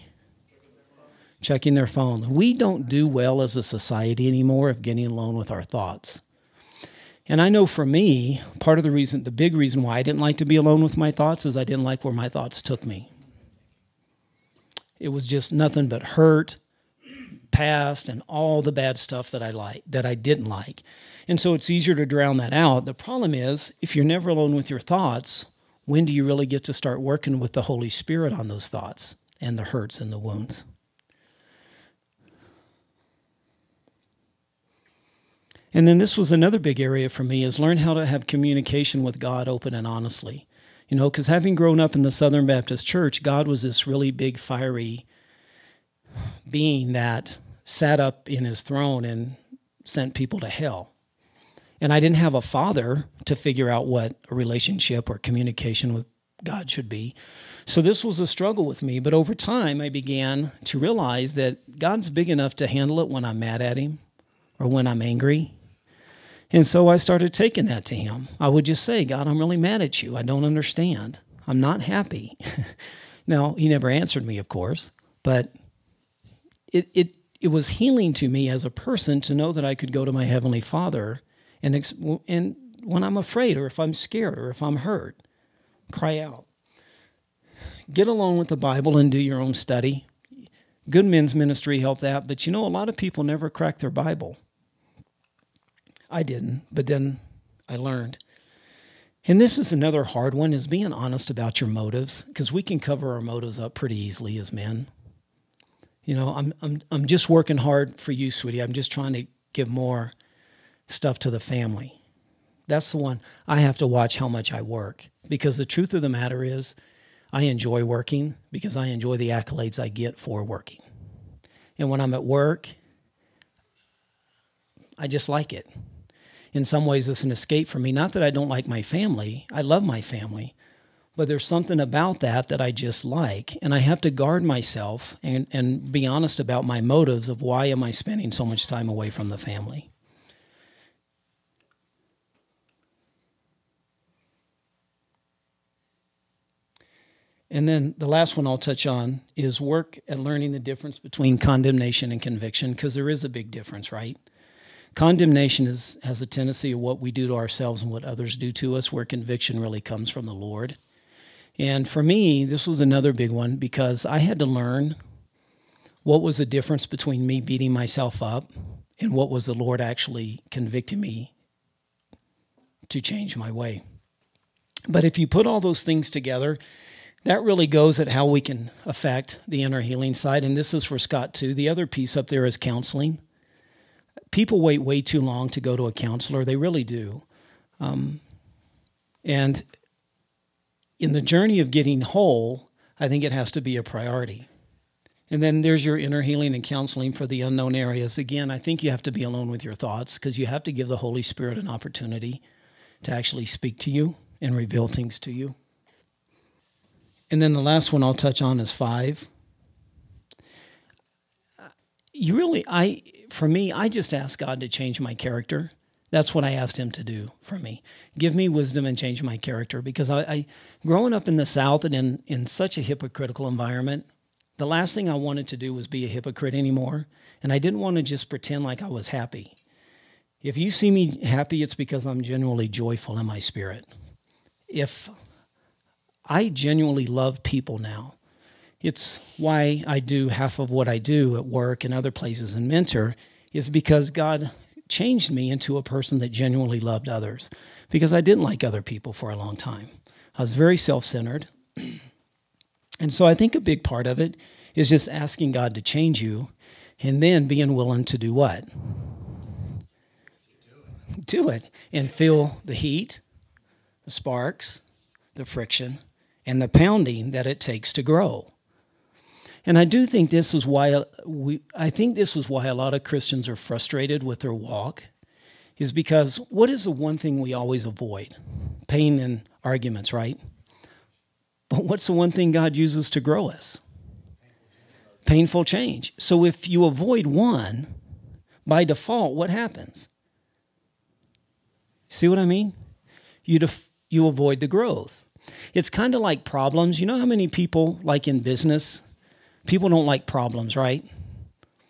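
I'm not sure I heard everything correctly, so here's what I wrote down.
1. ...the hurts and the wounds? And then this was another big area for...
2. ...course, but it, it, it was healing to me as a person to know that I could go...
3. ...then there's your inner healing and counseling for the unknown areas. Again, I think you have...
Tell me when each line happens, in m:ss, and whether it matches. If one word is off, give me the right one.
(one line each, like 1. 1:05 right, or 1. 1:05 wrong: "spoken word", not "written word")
1. 0:29 right
2. 1:14 right
3. 3:15 right.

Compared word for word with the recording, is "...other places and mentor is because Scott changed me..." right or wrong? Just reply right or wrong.
wrong.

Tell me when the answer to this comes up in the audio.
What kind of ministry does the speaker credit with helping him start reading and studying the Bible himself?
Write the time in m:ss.
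1:31.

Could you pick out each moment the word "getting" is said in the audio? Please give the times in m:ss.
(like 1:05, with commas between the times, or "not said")
0:04, 3:11.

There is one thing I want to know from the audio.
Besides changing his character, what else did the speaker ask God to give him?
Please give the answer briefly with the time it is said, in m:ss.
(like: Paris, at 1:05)
Wisdom, at 3:38.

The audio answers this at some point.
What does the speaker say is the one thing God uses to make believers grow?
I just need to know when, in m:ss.
4:45.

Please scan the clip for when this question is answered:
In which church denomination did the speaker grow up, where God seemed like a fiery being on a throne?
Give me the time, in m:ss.
0:42.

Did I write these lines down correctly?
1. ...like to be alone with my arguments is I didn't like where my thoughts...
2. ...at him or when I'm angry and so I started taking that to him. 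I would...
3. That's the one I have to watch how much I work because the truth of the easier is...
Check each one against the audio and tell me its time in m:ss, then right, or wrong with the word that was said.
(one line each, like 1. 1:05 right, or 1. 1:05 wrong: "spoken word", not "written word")
1. 0:10 wrong: "thoughts", not "arguments"
2. 1:03 right
3. 1:52 wrong: "matter", not "easier".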